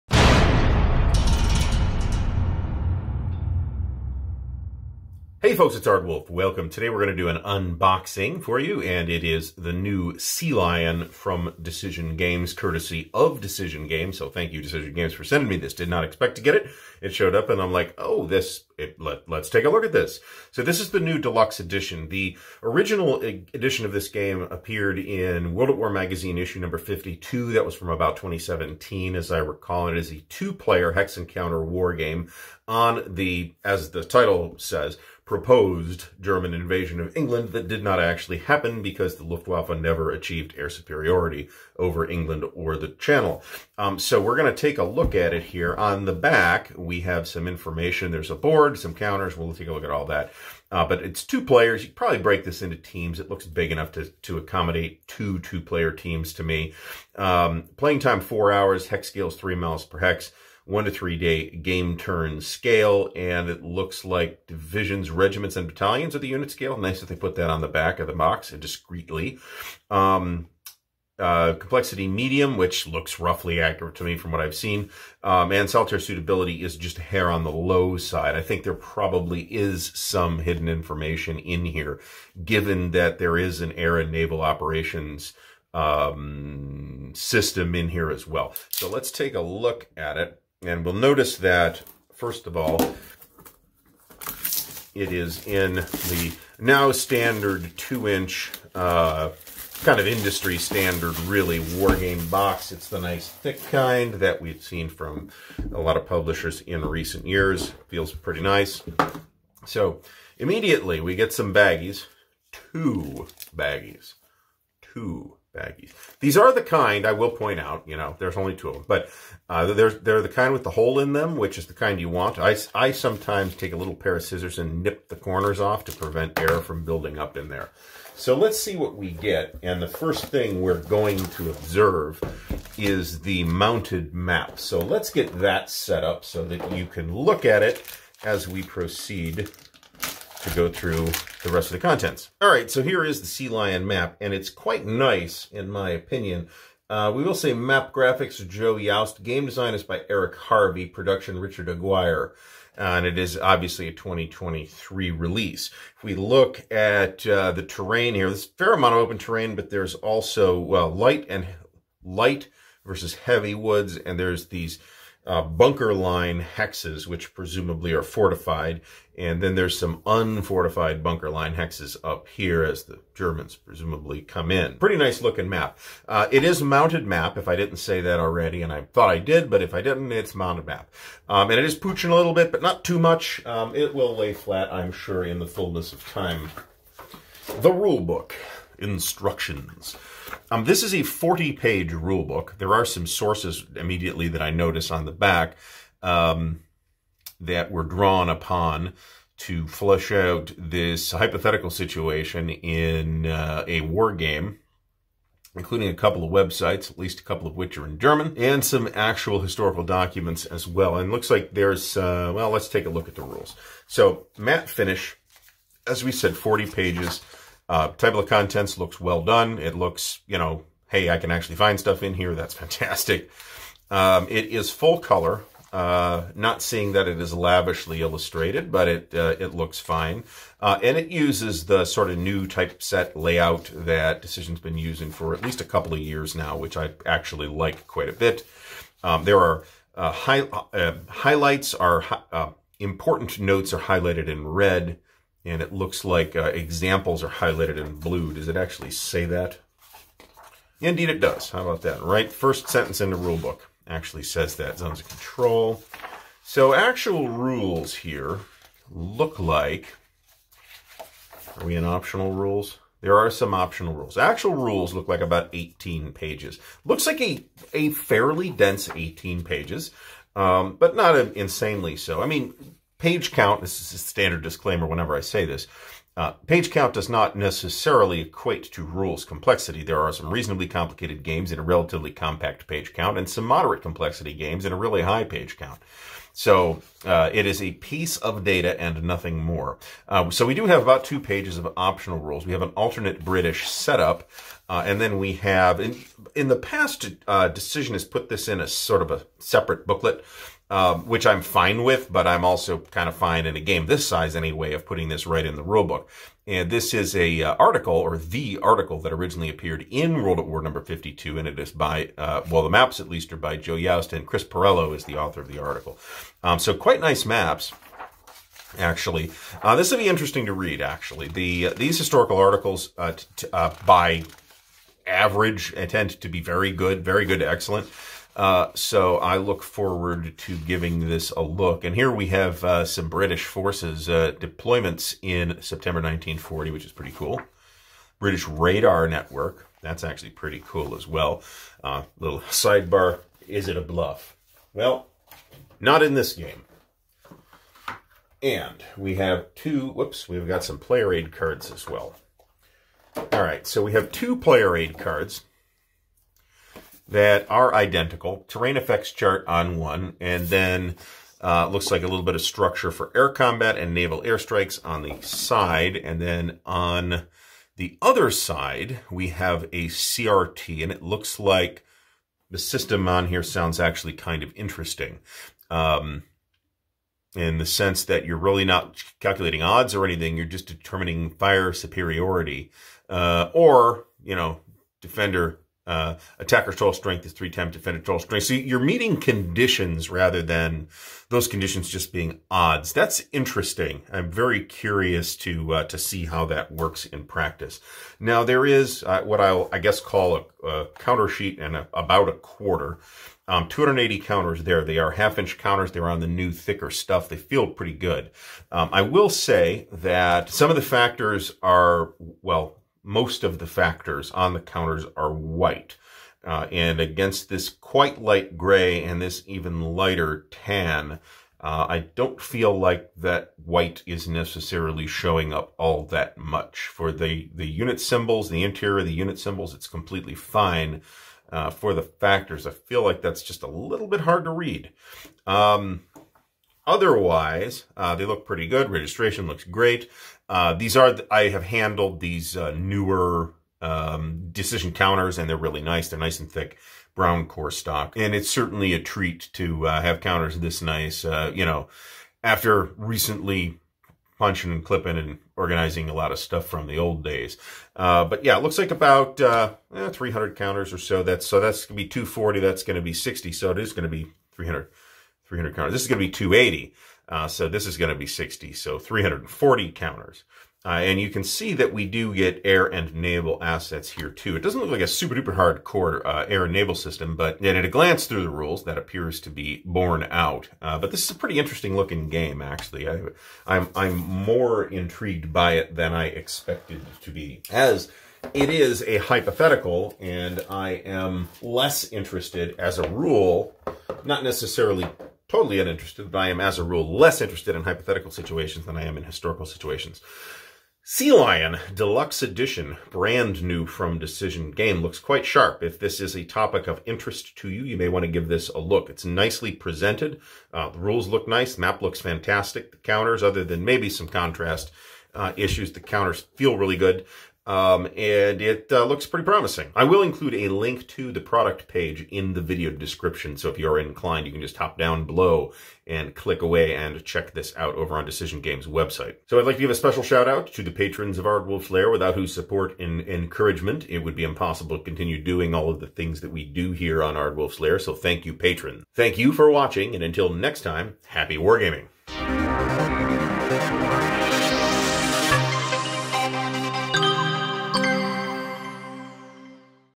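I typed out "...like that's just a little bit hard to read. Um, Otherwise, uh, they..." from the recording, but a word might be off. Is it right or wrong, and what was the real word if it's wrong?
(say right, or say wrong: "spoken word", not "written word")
right.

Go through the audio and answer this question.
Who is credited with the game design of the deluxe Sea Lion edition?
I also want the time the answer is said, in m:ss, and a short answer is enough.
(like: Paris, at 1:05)
Eric Harvey, at 2:30.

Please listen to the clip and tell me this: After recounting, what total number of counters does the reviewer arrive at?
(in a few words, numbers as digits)
340.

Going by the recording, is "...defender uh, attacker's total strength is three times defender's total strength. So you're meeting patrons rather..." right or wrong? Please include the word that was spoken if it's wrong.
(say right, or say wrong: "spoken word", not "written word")
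wrong: "conditions", not "patrons".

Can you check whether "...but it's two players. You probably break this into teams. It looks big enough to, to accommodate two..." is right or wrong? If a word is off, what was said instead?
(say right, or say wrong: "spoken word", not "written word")
right.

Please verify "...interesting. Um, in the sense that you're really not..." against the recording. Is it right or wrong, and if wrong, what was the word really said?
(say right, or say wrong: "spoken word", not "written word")
right.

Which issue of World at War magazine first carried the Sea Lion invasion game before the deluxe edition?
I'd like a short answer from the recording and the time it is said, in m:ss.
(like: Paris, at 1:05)
52, at 0:26.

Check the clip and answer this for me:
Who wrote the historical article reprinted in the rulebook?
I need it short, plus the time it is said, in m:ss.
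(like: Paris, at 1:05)
Chris Perello, at 5:14.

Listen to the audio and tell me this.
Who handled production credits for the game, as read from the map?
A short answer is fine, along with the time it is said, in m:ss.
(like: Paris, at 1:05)
Richard Aguirre, at 2:31.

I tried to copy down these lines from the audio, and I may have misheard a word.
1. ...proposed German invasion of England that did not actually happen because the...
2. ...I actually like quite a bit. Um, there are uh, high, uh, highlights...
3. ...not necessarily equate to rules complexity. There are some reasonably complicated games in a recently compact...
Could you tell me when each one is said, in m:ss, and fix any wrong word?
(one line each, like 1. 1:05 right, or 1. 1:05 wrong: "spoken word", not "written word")
1. 0:35 right
2. 3:56 right
3. 4:37 wrong: "relatively", not "recently".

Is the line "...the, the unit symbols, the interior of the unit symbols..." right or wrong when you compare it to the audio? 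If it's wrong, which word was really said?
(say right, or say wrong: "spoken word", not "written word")
right.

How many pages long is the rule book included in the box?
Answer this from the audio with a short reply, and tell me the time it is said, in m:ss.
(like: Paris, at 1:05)
40, at 3:10.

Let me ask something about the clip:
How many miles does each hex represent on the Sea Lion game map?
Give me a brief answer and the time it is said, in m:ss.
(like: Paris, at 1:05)
3 miles, at 0:59.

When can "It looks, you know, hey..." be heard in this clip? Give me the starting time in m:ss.
3:39.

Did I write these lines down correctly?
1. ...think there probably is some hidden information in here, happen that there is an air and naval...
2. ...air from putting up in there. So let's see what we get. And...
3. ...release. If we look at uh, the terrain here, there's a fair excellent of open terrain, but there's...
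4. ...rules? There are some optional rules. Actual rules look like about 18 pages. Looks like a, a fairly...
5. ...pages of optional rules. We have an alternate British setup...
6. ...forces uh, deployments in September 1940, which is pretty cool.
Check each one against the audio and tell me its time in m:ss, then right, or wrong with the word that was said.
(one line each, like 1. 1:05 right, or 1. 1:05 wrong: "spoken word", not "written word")
1. 1:18 wrong: "given", not "happen"
2. 2:06 wrong: "building", not "putting"
3. 2:35 wrong: "amount", not "excellent"
4. 4:22 right
5. 4:51 right
6. 5:33 right.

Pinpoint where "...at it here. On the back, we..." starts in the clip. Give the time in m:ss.
0:45.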